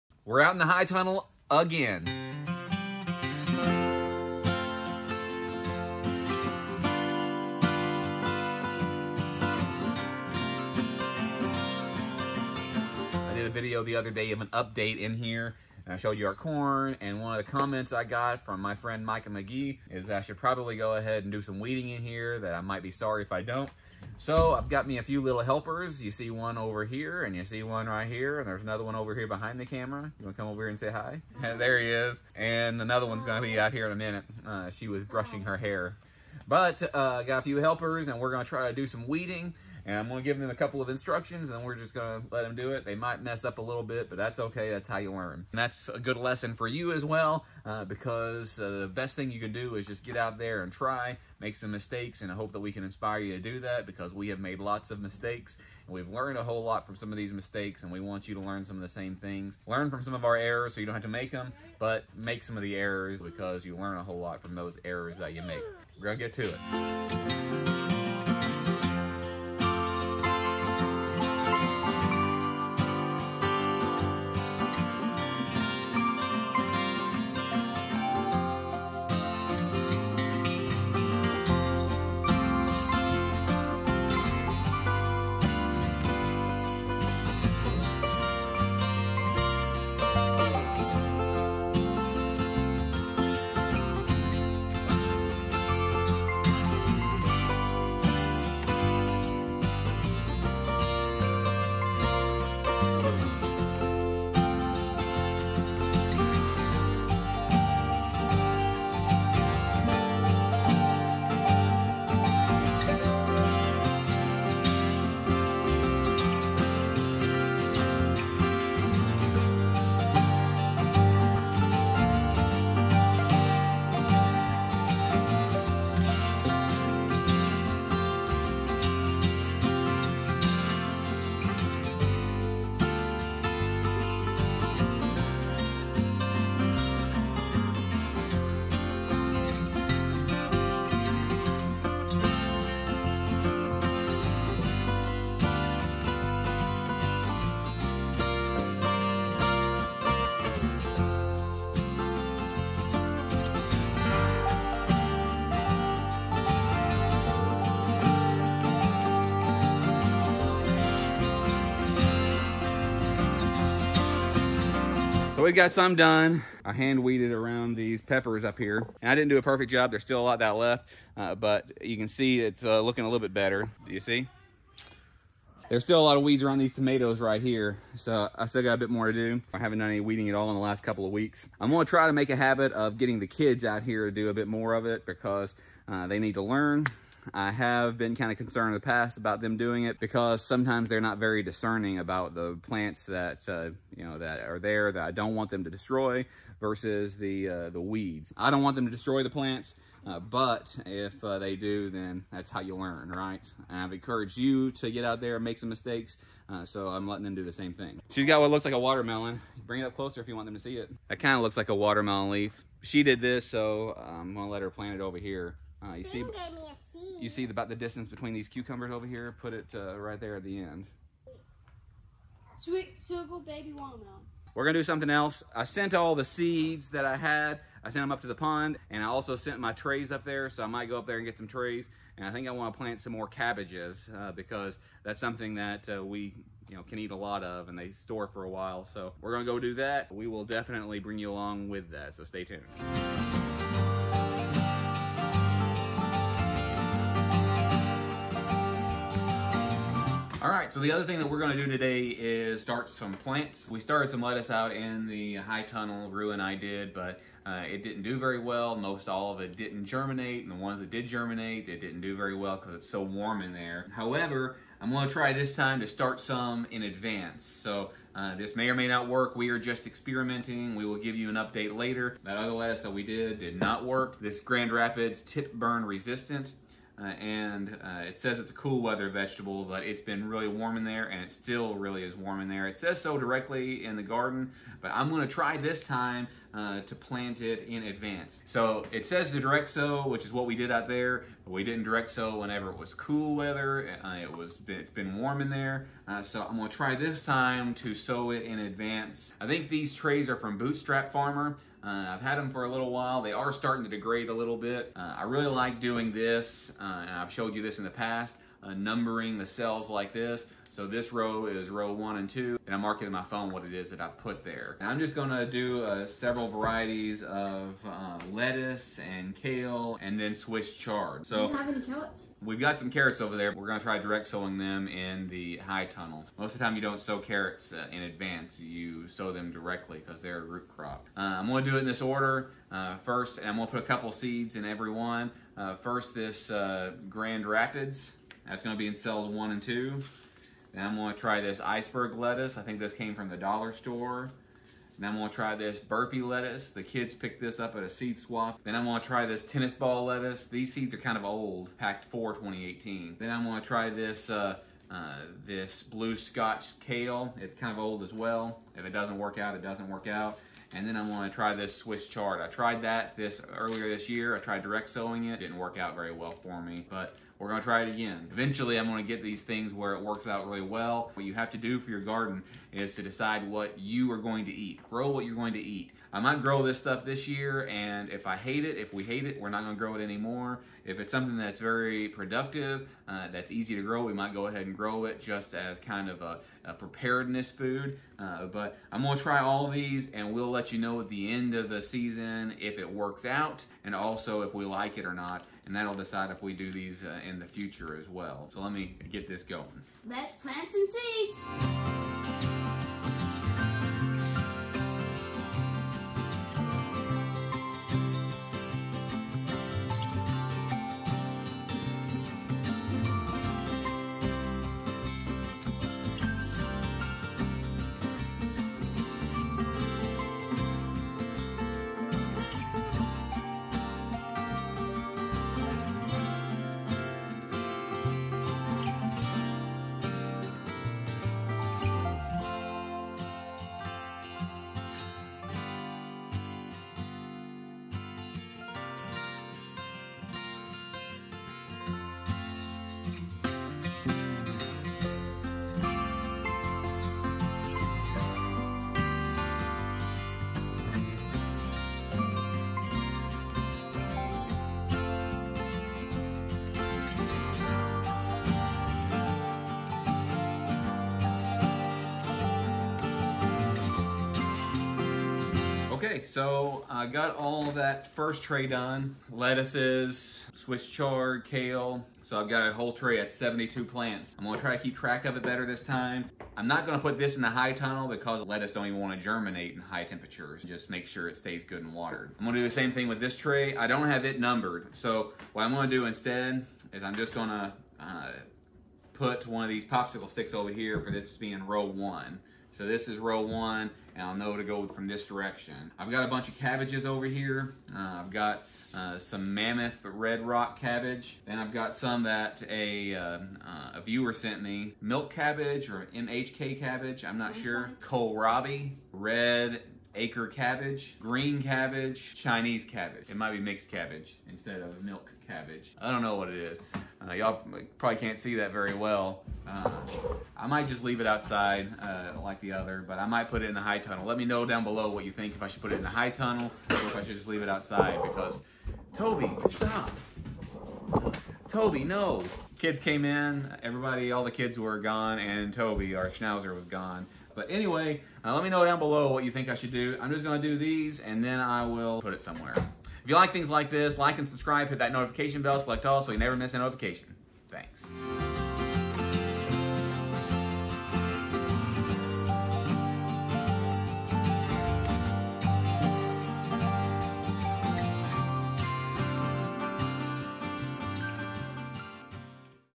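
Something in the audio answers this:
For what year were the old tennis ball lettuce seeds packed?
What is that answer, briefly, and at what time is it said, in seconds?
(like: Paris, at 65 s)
2018, at 352 s.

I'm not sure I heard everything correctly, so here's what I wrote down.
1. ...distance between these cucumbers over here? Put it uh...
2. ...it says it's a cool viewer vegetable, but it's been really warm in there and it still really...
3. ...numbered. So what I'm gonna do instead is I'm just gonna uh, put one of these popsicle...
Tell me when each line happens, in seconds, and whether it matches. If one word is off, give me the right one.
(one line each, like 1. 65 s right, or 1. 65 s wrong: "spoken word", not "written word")
1. 217 s right
2. 278 s wrong: "weather", not "viewer"
3. 484 s right.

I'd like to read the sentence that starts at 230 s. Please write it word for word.
So I might go up there and get some trays.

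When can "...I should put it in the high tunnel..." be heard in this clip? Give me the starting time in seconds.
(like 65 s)
525 s.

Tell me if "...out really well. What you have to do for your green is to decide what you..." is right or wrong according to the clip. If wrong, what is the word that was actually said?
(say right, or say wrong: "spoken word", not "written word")
wrong: "garden", not "green".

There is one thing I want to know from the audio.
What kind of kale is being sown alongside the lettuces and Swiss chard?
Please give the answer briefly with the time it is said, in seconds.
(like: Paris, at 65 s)
blue scotch kale, at 355 s.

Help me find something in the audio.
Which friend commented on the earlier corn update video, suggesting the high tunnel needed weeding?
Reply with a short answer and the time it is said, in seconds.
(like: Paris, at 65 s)
Micah McGie, at 19 s.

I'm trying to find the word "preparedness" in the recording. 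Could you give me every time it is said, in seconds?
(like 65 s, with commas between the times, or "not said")
386 s.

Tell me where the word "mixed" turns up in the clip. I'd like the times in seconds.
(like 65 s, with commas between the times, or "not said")
513 s.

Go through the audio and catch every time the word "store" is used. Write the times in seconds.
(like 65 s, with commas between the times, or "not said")
237 s, 343 s.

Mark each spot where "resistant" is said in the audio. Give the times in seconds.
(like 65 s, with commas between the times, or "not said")
275 s.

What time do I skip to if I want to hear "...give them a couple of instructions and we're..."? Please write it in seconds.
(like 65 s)
40 s.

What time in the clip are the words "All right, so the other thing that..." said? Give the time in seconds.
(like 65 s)
250 s.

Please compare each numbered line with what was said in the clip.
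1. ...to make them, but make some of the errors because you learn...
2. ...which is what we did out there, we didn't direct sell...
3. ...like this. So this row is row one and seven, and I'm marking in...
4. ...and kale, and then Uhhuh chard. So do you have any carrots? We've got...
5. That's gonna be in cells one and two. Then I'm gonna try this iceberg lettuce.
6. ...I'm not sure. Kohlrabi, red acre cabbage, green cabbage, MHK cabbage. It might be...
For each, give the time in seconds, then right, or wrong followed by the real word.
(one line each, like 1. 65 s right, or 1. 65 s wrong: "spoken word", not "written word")
1. 61 s right
2. 290 s right
3. 309 s wrong: "two", not "seven"
4. 318 s wrong: "Swiss", not "Uhhuh"
5. 338 s right
6. 507 s wrong: "Chinese", not "MHK".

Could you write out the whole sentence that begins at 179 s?
I haven't done any weeding at all in the last couple of weeks.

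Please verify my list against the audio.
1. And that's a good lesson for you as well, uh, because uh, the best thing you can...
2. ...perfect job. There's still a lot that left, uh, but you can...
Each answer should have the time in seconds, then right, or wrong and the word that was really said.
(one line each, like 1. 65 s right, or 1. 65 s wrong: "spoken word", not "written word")
1. 45 s right
2. 169 s right.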